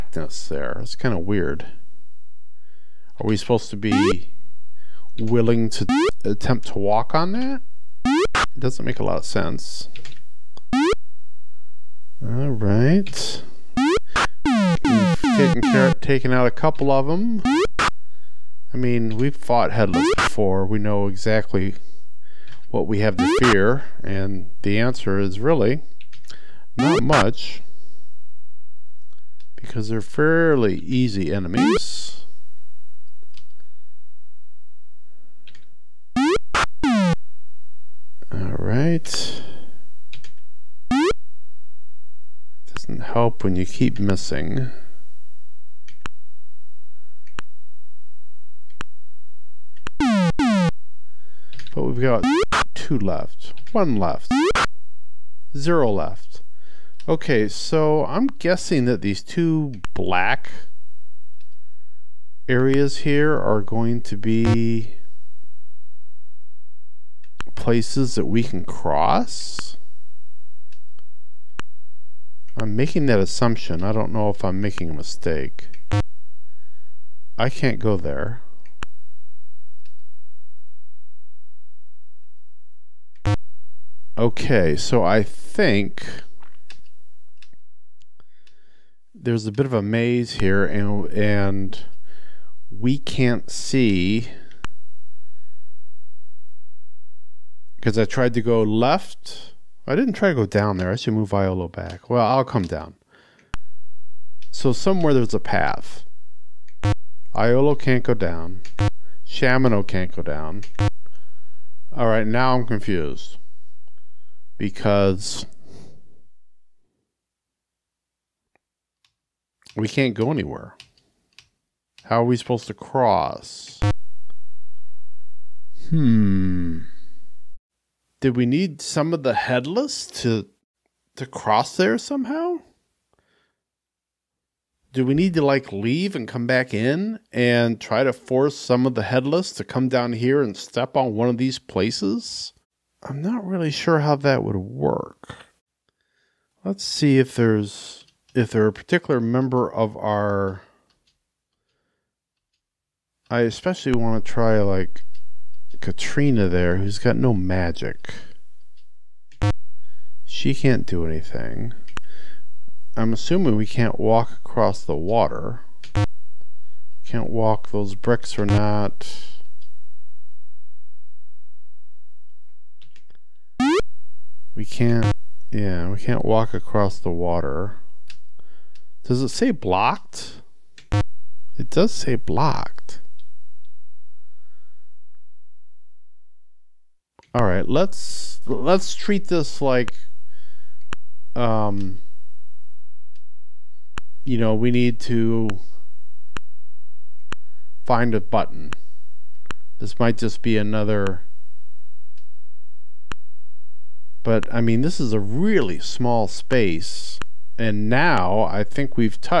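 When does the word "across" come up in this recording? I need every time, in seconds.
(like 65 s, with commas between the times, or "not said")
164 s, 176 s.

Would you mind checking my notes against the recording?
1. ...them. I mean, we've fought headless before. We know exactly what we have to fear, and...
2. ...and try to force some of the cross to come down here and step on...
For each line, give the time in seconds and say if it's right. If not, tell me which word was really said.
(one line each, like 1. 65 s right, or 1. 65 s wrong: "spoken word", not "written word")
1. 17 s right
2. 137 s wrong: "headless", not "cross".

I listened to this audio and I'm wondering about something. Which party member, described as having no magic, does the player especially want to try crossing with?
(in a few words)
Katrina.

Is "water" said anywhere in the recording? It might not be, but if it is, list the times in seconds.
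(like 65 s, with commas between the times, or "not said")
164 s, 177 s.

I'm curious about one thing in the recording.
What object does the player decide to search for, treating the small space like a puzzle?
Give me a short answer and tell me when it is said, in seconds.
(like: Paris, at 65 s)
A button, at 198 s.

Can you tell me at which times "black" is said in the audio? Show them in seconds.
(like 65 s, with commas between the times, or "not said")
59 s.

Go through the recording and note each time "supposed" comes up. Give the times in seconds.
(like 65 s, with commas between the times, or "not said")
3 s, 122 s.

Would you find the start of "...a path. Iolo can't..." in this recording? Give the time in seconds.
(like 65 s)
105 s.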